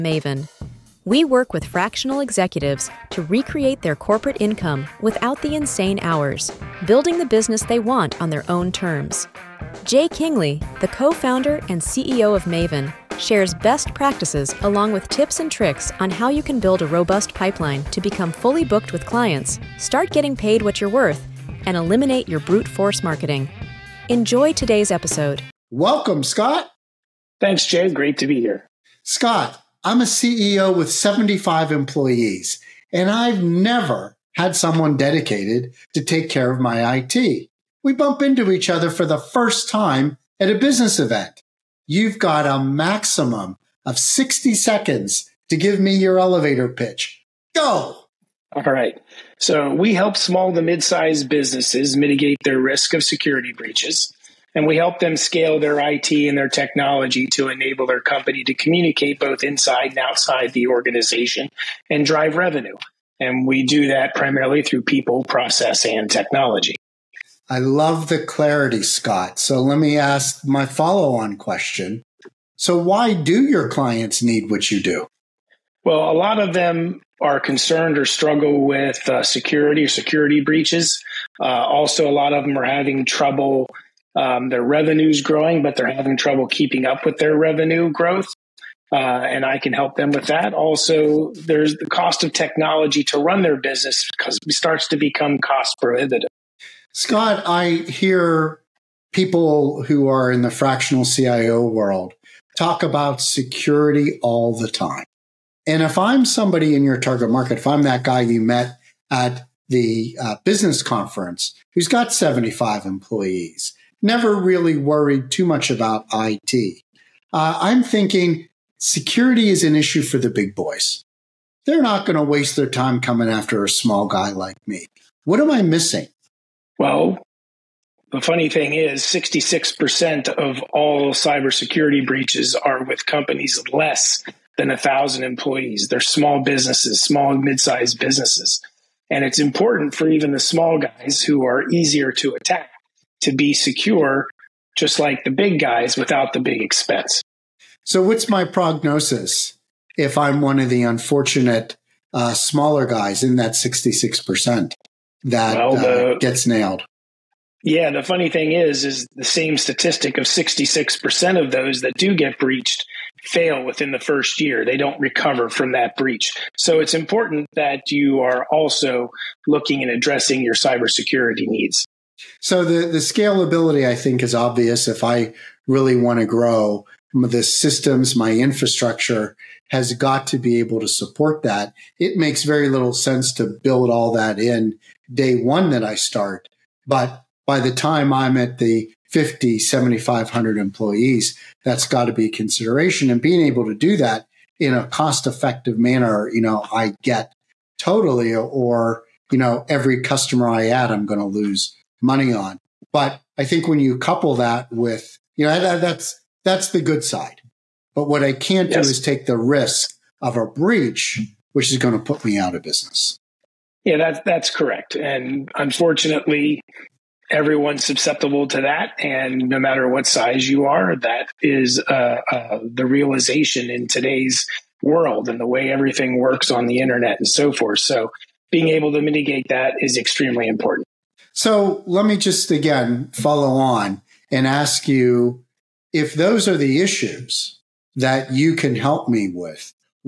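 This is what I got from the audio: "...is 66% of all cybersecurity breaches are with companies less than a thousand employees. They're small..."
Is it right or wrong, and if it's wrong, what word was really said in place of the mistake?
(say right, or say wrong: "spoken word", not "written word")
right.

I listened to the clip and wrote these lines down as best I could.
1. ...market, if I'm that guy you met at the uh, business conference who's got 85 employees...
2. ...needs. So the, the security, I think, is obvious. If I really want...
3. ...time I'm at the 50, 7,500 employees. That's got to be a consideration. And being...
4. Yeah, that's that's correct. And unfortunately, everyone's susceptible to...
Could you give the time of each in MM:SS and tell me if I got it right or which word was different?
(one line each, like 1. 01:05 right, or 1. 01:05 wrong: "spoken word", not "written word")
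1. 01:47 wrong: "75", not "85"
2. 02:51 wrong: "scalability", not "security"
3. 03:07 right
4. 03:33 right.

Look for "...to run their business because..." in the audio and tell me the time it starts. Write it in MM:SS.
01:33.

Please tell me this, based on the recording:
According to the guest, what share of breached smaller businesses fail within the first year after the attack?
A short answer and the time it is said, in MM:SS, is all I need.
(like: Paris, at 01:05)
66%, at 02:40.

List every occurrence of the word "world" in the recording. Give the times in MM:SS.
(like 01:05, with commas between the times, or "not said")
01:41, 03:44.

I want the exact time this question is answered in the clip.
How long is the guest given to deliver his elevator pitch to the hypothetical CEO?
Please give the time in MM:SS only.
00:43.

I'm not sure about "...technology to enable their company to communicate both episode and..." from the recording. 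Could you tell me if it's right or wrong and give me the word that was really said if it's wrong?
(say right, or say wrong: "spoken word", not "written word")
wrong: "inside", not "episode".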